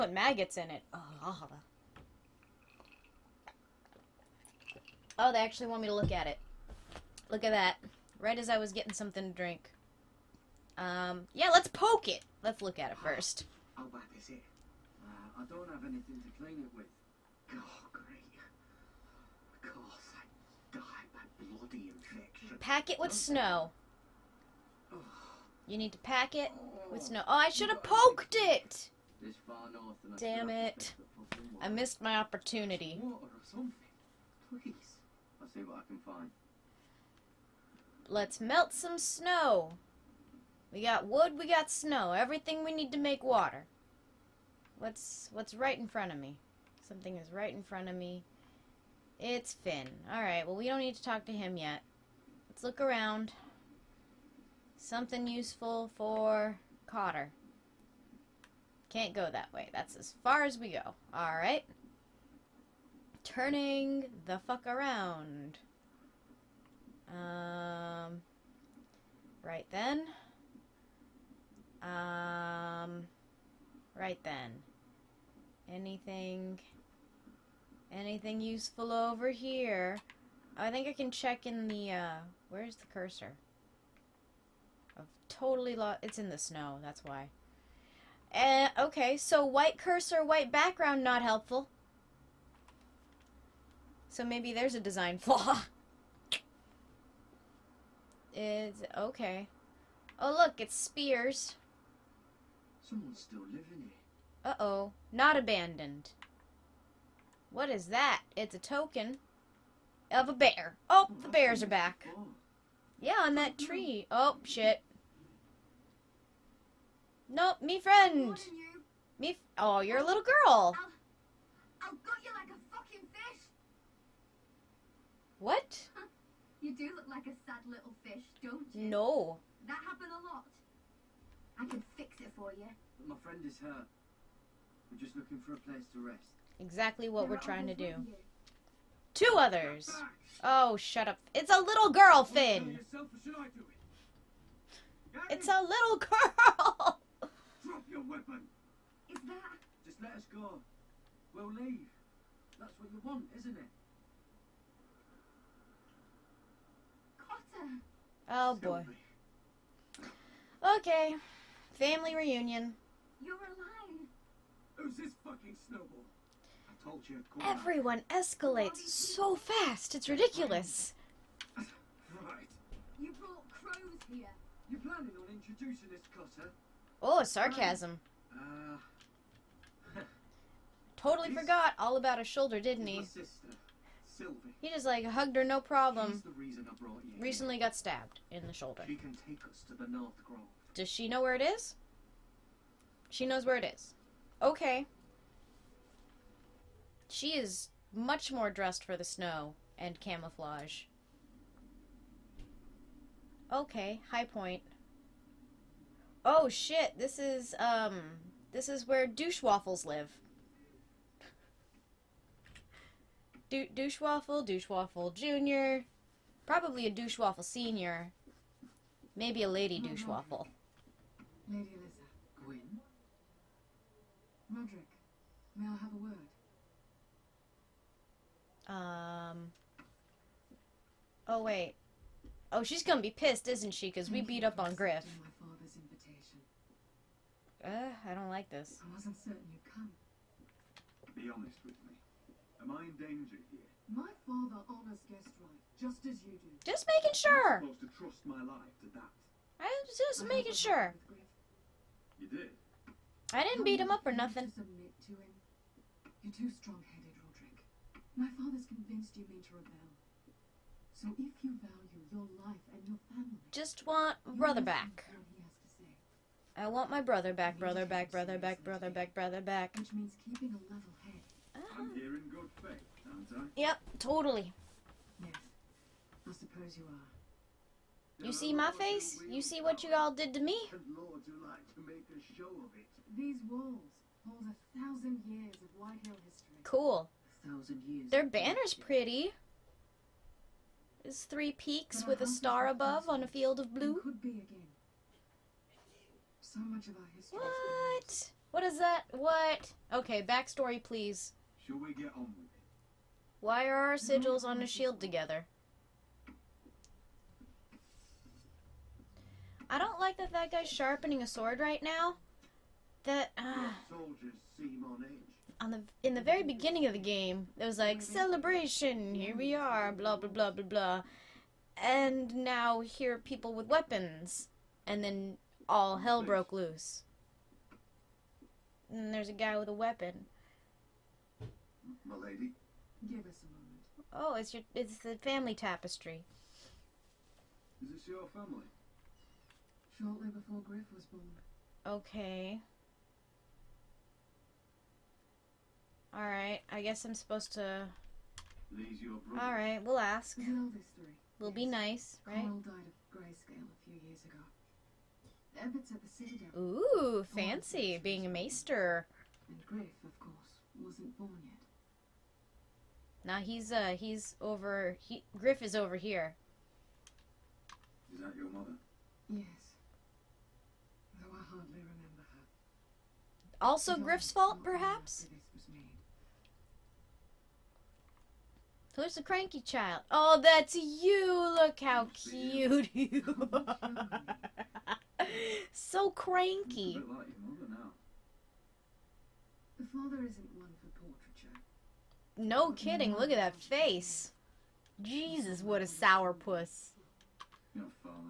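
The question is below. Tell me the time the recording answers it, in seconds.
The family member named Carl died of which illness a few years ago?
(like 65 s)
353 s.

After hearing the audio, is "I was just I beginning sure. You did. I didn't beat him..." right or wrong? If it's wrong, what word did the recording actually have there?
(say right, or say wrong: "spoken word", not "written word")
wrong: "making", not "beginning".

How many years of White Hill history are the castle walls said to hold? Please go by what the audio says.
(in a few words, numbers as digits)
1000.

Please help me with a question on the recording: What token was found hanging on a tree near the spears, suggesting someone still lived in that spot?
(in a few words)
A token of a bear.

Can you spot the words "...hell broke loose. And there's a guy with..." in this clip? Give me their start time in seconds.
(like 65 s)
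325 s.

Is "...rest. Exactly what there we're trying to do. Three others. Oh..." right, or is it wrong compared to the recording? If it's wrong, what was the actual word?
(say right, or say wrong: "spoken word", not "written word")
wrong: "Two", not "Three".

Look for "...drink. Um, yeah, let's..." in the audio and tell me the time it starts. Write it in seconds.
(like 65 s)
9 s.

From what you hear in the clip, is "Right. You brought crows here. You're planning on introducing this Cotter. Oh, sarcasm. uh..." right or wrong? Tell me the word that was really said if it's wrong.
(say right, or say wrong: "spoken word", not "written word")
right.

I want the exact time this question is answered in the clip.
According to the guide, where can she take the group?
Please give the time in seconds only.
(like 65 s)
189 s.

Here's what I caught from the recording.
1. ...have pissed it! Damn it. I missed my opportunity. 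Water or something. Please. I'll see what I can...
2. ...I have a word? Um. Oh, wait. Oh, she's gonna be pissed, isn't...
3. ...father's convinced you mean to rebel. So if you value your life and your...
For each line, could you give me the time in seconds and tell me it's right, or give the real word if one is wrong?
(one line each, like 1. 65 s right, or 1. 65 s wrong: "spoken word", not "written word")
1. 27 s wrong: "poked", not "pissed"
2. 225 s right
3. 258 s right.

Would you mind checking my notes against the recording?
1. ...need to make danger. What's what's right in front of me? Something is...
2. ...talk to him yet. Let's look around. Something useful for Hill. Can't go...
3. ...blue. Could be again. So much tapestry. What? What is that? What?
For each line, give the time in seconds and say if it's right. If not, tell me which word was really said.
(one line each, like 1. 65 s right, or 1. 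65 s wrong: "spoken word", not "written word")
1. 42 s wrong: "water", not "danger"
2. 51 s wrong: "Cotter", not "Hill"
3. 293 s wrong: "history", not "tapestry".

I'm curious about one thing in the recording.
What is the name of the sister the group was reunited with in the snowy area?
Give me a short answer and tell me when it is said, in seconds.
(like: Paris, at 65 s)
Sylvie, at 184 s.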